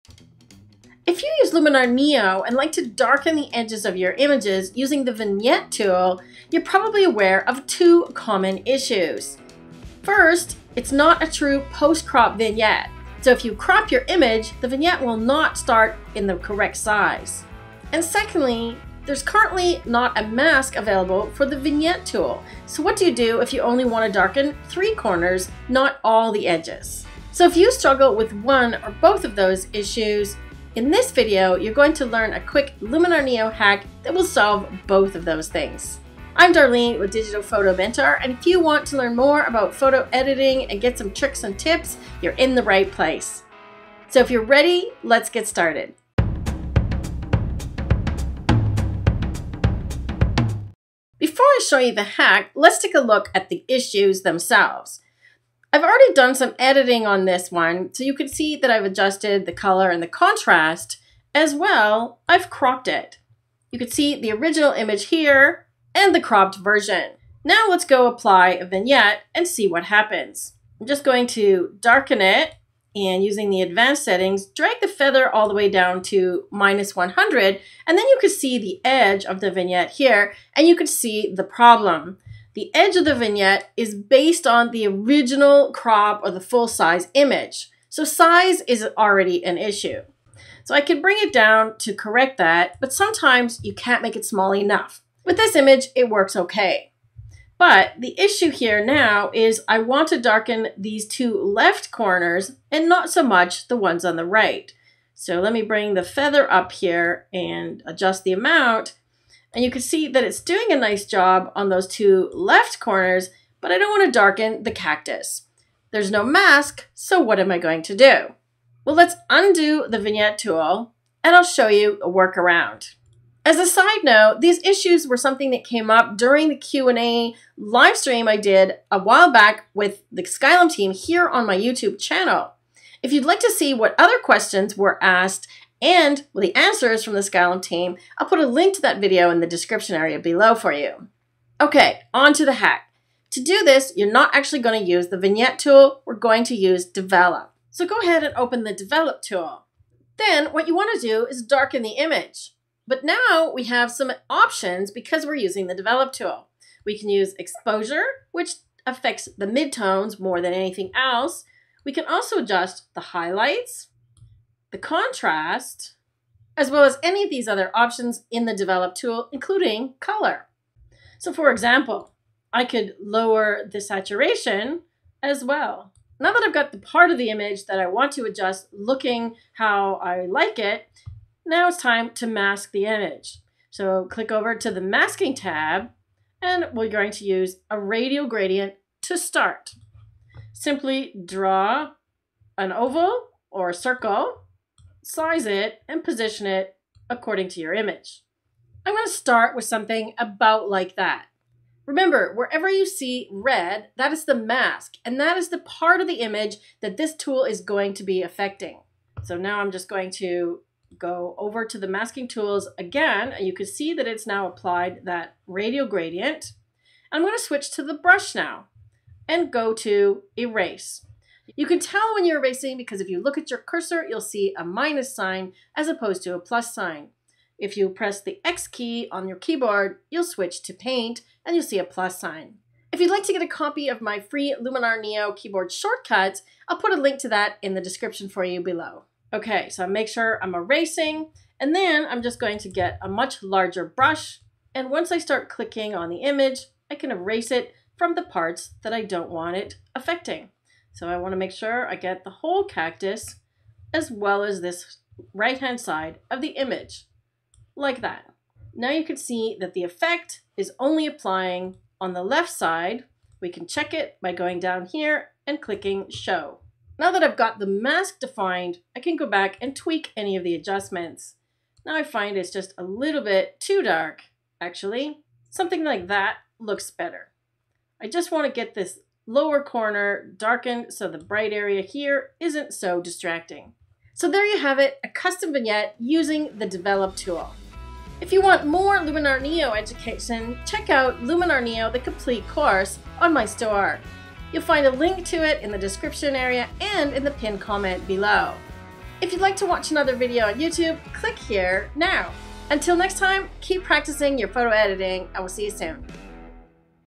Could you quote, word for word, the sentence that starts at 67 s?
Now let's go apply a vignette and see what happens.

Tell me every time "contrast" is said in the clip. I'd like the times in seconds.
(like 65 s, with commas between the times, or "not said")
60 s, 164 s.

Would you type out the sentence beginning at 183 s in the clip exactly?
So click over to the masking tab and we're going to use a radial gradient to start.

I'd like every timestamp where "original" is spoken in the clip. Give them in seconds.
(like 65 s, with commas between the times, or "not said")
64 s, 84 s.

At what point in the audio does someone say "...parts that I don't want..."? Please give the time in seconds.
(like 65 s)
248 s.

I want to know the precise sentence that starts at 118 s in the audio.
Well, let's undo the vignette tool and I'll show you a workaround.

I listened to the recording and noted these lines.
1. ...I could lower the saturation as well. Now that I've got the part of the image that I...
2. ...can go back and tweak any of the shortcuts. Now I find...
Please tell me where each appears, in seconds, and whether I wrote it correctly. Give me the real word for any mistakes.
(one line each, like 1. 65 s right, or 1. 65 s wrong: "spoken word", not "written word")
1. 172 s right
2. 268 s wrong: "adjustments", not "shortcuts".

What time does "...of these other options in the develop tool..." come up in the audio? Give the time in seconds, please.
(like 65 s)
167 s.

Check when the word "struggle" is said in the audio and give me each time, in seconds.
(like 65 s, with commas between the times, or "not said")
27 s.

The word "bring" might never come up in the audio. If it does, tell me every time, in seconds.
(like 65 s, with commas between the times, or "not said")
91 s, 105 s.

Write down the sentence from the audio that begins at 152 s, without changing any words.
But now we have some options because we're using the develop tool.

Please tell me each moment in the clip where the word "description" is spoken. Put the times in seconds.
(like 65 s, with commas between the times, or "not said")
139 s, 237 s, 295 s.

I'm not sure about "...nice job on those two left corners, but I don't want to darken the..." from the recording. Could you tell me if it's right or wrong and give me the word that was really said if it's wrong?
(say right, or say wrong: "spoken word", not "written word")
right.